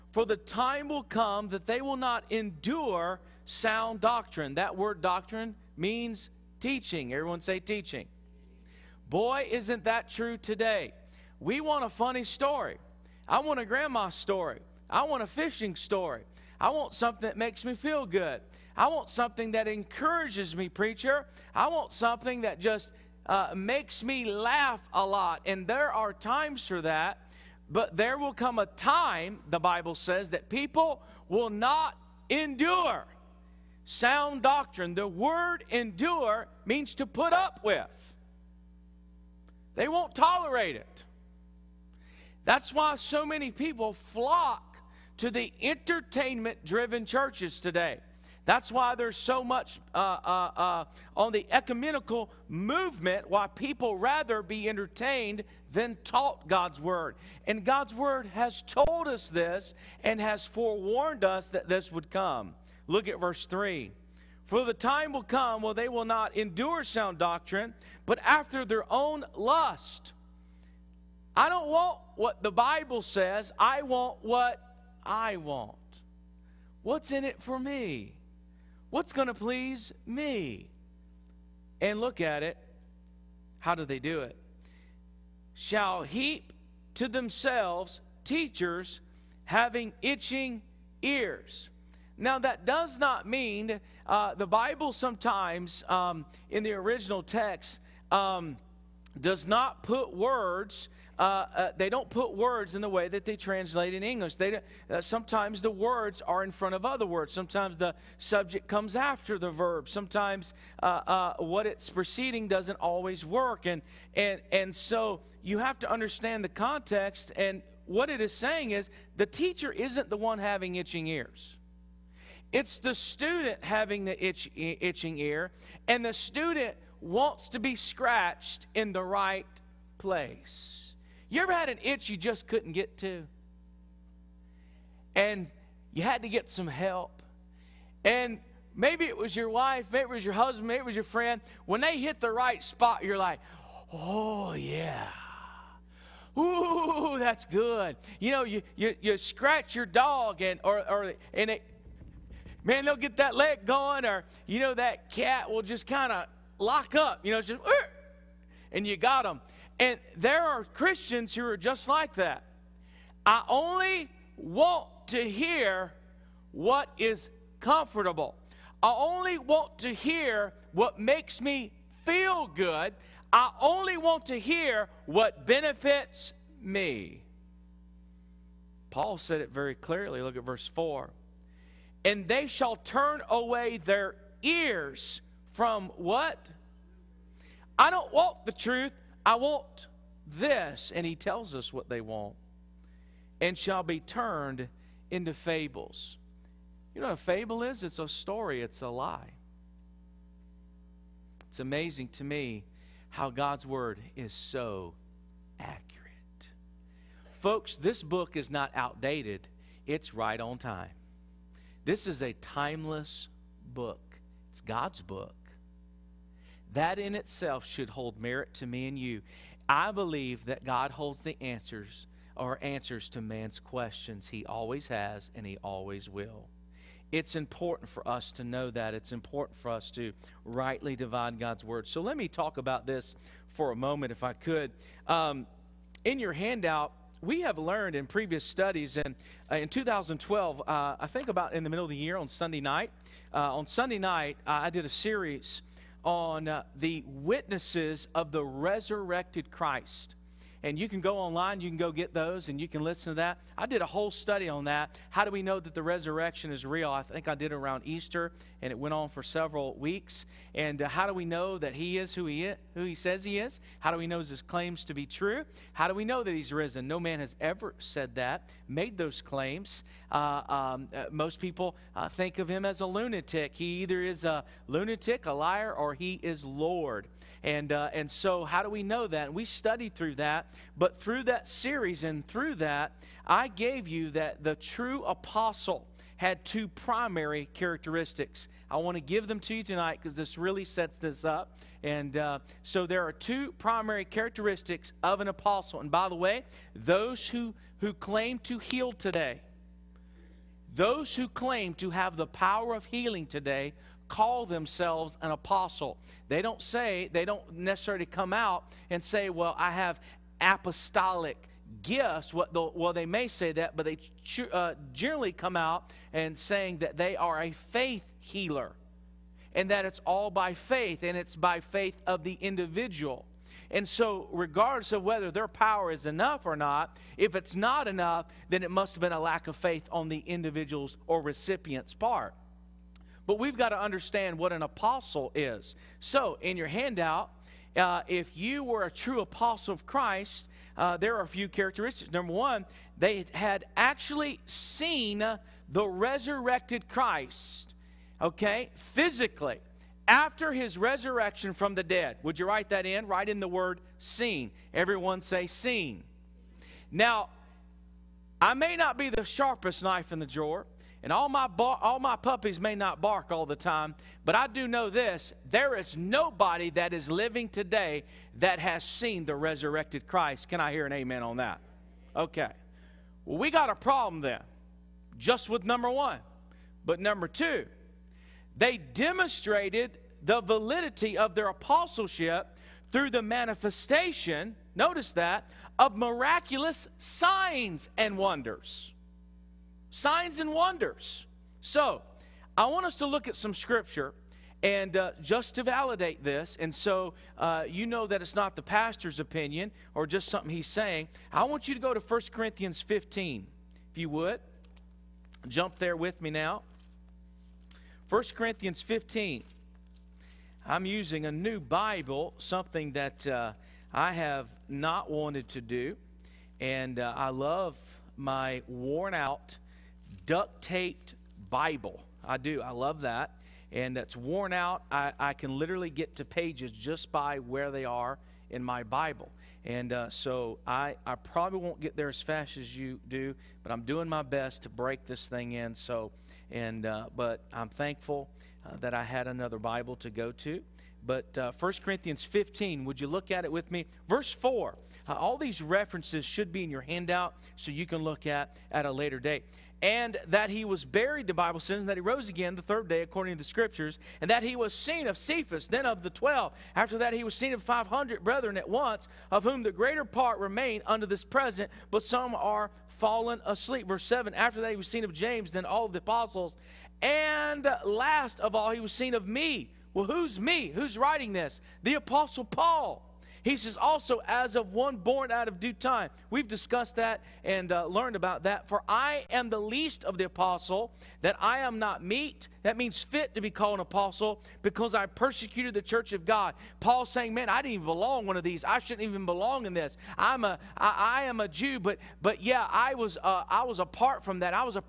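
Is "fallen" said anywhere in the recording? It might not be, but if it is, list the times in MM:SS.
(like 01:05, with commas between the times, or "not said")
07:42.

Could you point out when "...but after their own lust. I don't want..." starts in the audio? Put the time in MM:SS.
01:08.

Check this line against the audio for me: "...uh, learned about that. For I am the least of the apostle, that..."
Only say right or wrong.
right.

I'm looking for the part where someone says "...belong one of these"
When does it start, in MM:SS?
08:07.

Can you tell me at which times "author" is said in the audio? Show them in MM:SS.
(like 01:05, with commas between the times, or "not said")
not said.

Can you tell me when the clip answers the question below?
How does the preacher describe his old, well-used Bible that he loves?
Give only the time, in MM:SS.
06:58.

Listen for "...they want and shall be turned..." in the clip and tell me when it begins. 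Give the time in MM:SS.
03:11.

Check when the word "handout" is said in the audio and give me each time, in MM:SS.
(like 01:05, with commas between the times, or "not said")
03:56, 05:36, 07:26.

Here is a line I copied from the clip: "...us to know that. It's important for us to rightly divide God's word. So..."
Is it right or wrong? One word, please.
right.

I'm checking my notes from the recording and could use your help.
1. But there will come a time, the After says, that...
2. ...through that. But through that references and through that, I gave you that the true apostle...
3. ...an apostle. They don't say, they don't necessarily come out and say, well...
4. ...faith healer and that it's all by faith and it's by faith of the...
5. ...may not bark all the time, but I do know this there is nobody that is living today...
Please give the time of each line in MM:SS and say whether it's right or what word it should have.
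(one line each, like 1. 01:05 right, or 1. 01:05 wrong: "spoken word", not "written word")
1. 00:27 wrong: "Bible", not "After"
2. 04:39 wrong: "series", not "references"
3. 05:05 right
4. 05:17 right
5. 06:02 right.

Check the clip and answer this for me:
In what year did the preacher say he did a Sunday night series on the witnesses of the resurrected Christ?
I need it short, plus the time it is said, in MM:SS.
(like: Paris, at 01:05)
2012, at 03:59.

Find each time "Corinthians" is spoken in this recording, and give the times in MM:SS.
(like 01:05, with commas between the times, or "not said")
06:42, 06:48, 07:21.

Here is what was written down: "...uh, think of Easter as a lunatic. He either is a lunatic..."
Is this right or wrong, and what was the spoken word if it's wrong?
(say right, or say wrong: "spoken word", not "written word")
wrong: "Him", not "Easter".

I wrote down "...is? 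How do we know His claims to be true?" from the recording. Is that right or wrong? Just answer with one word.
right.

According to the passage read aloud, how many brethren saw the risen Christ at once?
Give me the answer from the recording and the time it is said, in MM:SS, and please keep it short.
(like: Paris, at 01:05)
500, at 07:37.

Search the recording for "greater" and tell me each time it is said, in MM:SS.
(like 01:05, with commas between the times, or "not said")
07:39.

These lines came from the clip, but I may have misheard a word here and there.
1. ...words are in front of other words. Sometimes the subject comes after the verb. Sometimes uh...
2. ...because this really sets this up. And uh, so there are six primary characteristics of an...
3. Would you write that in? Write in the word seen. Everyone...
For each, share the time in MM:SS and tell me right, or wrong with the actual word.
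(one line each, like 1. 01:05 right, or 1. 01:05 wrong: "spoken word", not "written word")
1. 01:45 right
2. 04:50 wrong: "two", not "six"
3. 05:52 right.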